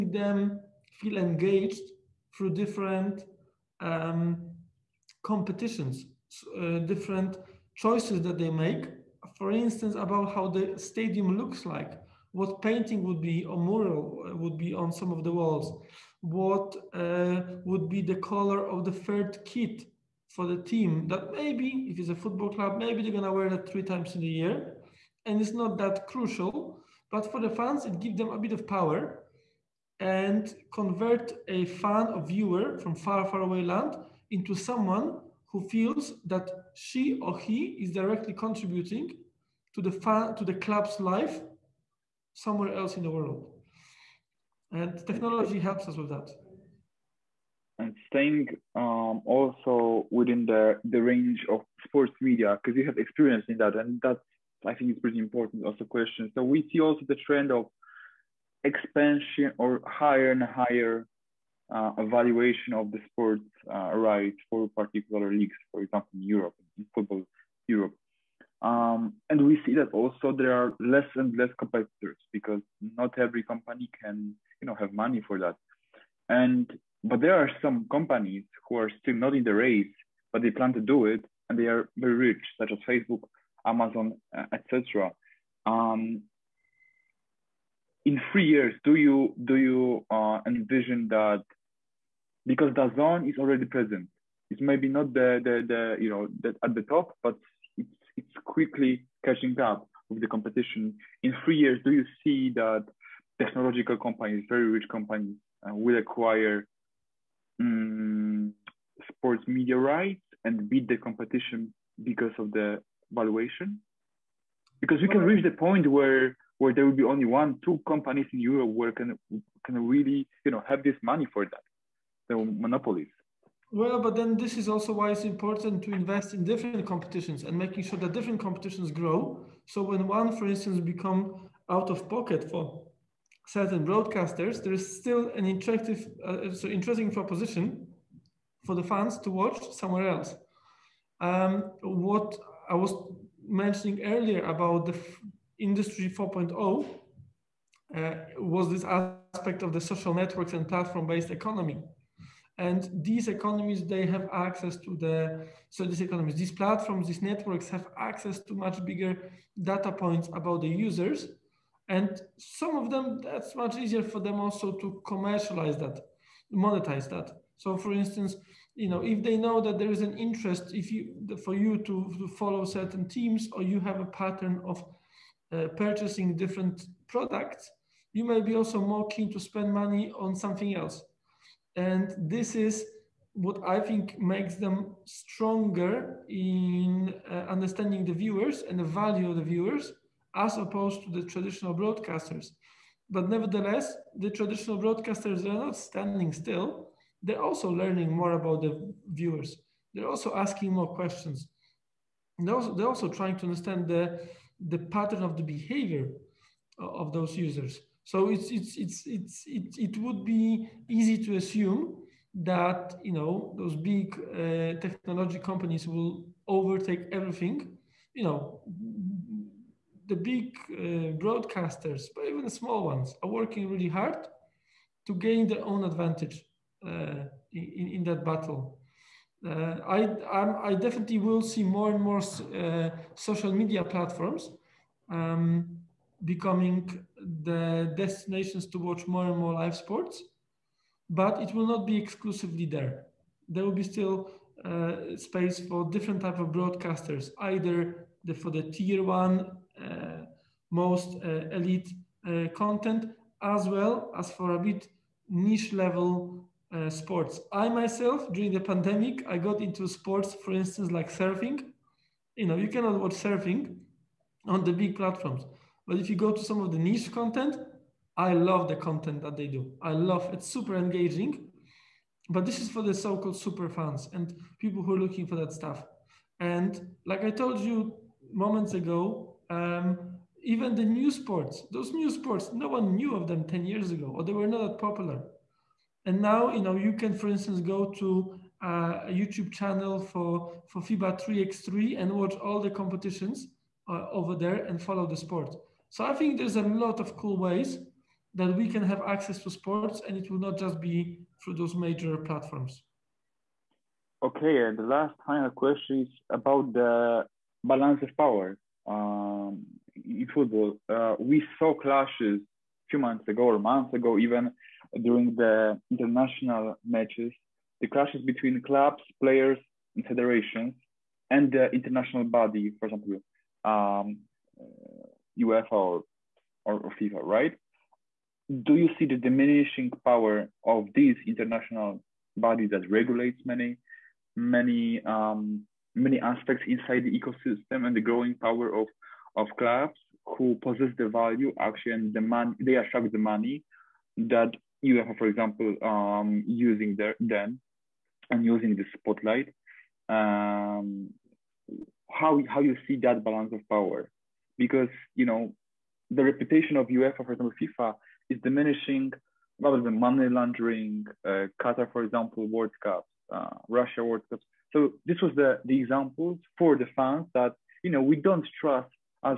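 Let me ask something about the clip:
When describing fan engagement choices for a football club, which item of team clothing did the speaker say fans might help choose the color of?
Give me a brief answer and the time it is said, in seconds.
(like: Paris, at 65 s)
third kit, at 18 s.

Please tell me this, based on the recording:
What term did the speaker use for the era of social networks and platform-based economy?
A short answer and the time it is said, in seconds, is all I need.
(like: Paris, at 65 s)
industry 4.0, at 145 s.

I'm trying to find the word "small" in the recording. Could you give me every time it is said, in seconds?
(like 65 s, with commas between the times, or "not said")
222 s.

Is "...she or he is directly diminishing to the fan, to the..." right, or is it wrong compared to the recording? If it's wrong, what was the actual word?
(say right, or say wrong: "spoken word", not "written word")
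wrong: "contributing", not "diminishing".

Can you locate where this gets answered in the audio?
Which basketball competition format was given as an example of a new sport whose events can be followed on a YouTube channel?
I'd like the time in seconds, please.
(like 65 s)
290 s.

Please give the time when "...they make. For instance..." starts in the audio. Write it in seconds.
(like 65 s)
8 s.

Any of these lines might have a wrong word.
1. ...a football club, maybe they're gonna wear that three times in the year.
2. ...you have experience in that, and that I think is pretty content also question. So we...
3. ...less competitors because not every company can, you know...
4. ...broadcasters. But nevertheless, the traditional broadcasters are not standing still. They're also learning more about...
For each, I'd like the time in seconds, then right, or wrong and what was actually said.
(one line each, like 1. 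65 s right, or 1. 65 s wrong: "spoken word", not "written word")
1. 22 s right
2. 52 s wrong: "important", not "content"
3. 71 s right
4. 191 s right.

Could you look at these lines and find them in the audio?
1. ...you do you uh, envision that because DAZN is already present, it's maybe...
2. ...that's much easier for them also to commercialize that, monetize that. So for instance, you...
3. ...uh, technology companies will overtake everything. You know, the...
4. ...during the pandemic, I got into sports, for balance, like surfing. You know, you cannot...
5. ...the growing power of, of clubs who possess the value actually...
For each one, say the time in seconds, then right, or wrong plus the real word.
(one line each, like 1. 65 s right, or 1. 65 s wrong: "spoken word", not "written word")
1. 88 s right
2. 163 s right
3. 214 s right
4. 258 s wrong: "instance", not "balance"
5. 337 s right.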